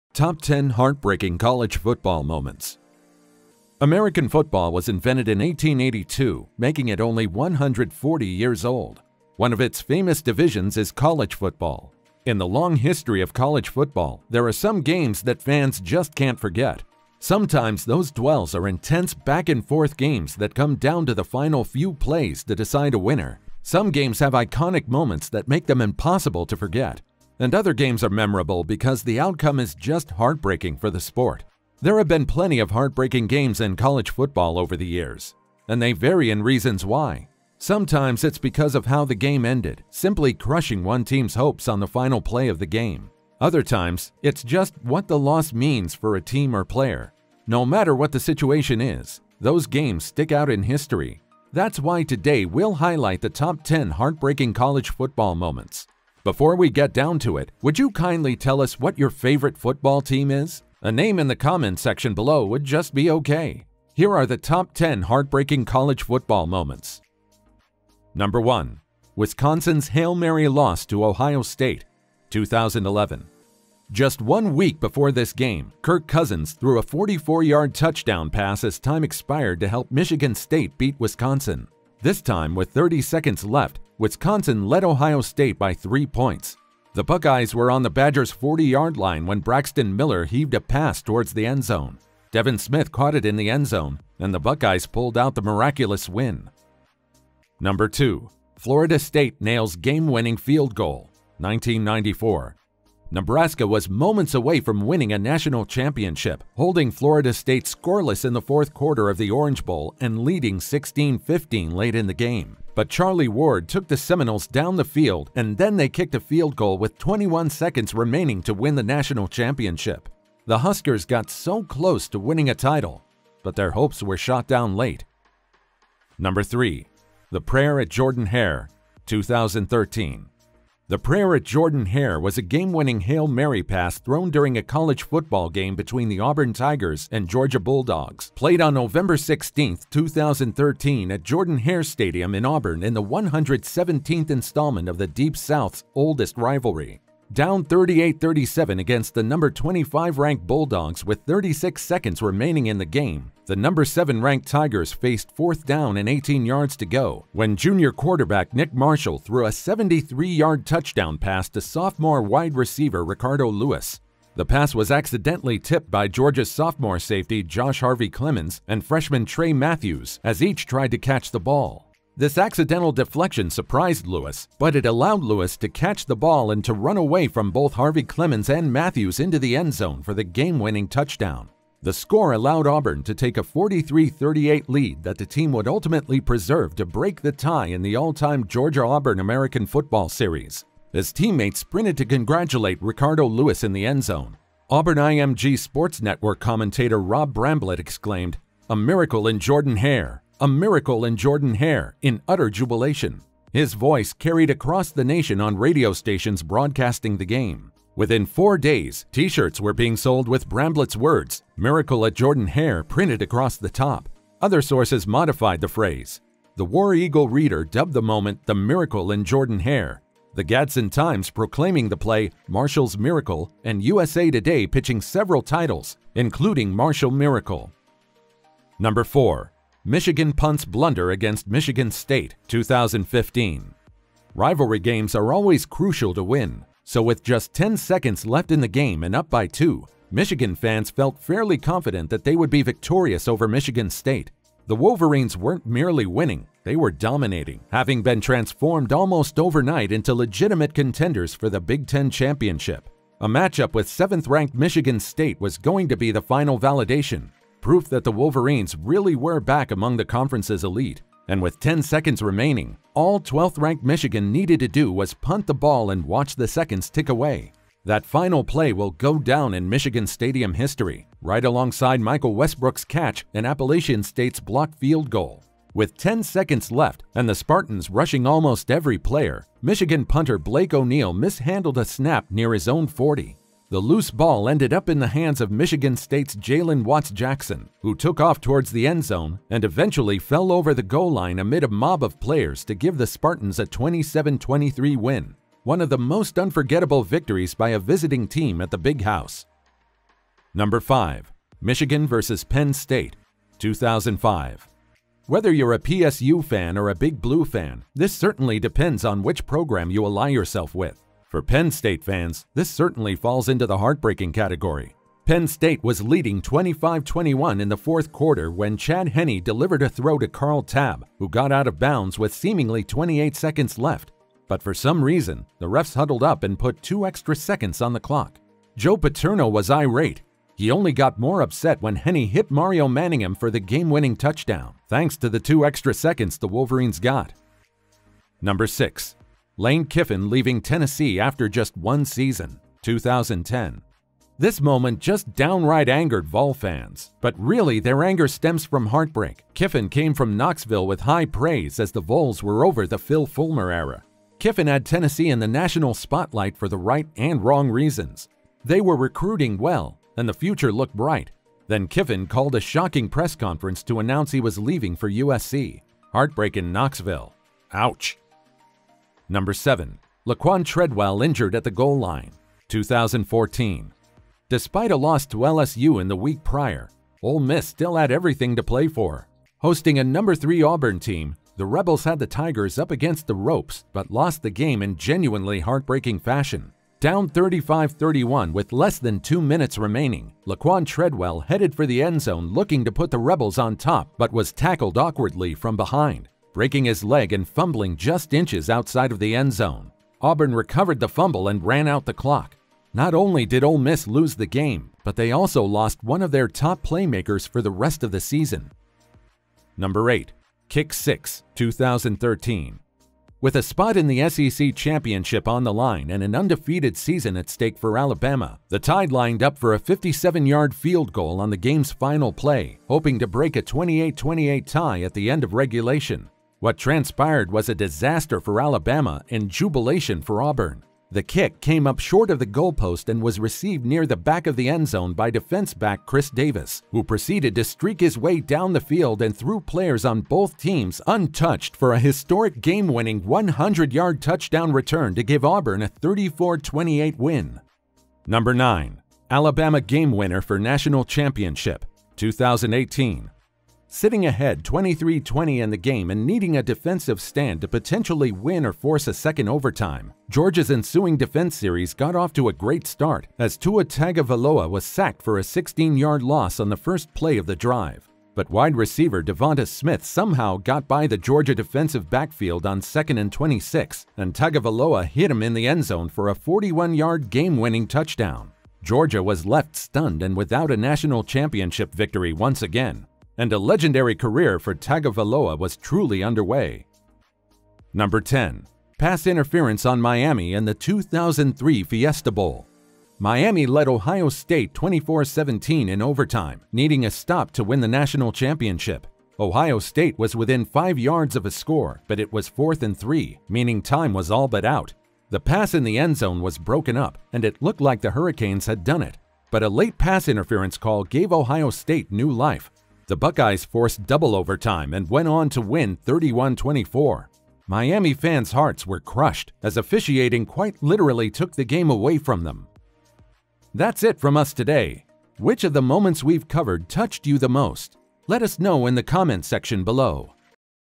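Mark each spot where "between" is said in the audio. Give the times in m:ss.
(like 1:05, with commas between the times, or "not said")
2:15.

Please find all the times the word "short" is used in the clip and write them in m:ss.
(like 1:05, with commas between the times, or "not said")
7:11.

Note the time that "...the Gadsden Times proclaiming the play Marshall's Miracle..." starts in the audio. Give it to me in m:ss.
3:40.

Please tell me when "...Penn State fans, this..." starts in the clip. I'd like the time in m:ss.
5:11.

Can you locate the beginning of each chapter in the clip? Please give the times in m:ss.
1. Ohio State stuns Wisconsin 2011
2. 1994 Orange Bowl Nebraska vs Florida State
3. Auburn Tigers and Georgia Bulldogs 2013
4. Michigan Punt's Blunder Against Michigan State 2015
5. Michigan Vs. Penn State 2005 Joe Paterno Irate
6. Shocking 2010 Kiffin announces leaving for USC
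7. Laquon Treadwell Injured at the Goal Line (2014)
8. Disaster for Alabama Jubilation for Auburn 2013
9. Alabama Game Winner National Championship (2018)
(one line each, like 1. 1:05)
1. 1:08
2. 1:38
3. 2:06
4. 3:48
5. 5:01
6. 5:41
7. 6:10
8. 6:51
9. 7:29.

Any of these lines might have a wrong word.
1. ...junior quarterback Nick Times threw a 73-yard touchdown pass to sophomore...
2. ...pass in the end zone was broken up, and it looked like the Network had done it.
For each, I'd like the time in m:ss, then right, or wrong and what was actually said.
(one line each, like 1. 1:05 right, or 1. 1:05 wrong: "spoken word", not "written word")
1. 2:37 wrong: "Marshall", not "Times"
2. 8:25 wrong: "Hurricanes", not "Network".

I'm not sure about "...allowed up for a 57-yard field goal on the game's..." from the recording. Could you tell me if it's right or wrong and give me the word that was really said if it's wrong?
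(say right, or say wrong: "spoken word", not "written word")
wrong: "lined", not "allowed".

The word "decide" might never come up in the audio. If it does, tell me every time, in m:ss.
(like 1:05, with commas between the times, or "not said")
0:22.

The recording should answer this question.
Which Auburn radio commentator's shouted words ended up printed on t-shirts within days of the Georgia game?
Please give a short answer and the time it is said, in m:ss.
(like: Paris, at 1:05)
Rob Bramblett, at 3:17.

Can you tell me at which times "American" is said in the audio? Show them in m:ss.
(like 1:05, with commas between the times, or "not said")
0:03, 3:09.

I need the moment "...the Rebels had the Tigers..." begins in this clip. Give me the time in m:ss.
6:21.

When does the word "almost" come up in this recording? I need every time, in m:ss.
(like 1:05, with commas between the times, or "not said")
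4:08, 4:38.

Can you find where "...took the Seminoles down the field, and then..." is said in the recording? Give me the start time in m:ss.
1:53.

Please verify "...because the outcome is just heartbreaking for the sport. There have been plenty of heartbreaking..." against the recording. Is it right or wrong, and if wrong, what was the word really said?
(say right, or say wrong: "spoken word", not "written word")
right.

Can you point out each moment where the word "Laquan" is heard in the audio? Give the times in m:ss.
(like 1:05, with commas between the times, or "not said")
6:10, 6:30.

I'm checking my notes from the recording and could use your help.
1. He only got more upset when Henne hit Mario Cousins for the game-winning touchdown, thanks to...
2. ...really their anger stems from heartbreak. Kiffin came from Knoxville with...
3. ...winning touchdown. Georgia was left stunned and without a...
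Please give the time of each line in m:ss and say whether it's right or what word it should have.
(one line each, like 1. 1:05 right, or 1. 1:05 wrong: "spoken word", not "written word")
1. 5:30 wrong: "Manningham", not "Cousins"
2. 5:47 right
3. 7:57 right.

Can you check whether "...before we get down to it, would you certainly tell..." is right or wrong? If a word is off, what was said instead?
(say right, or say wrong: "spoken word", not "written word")
wrong: "kindly", not "certainly".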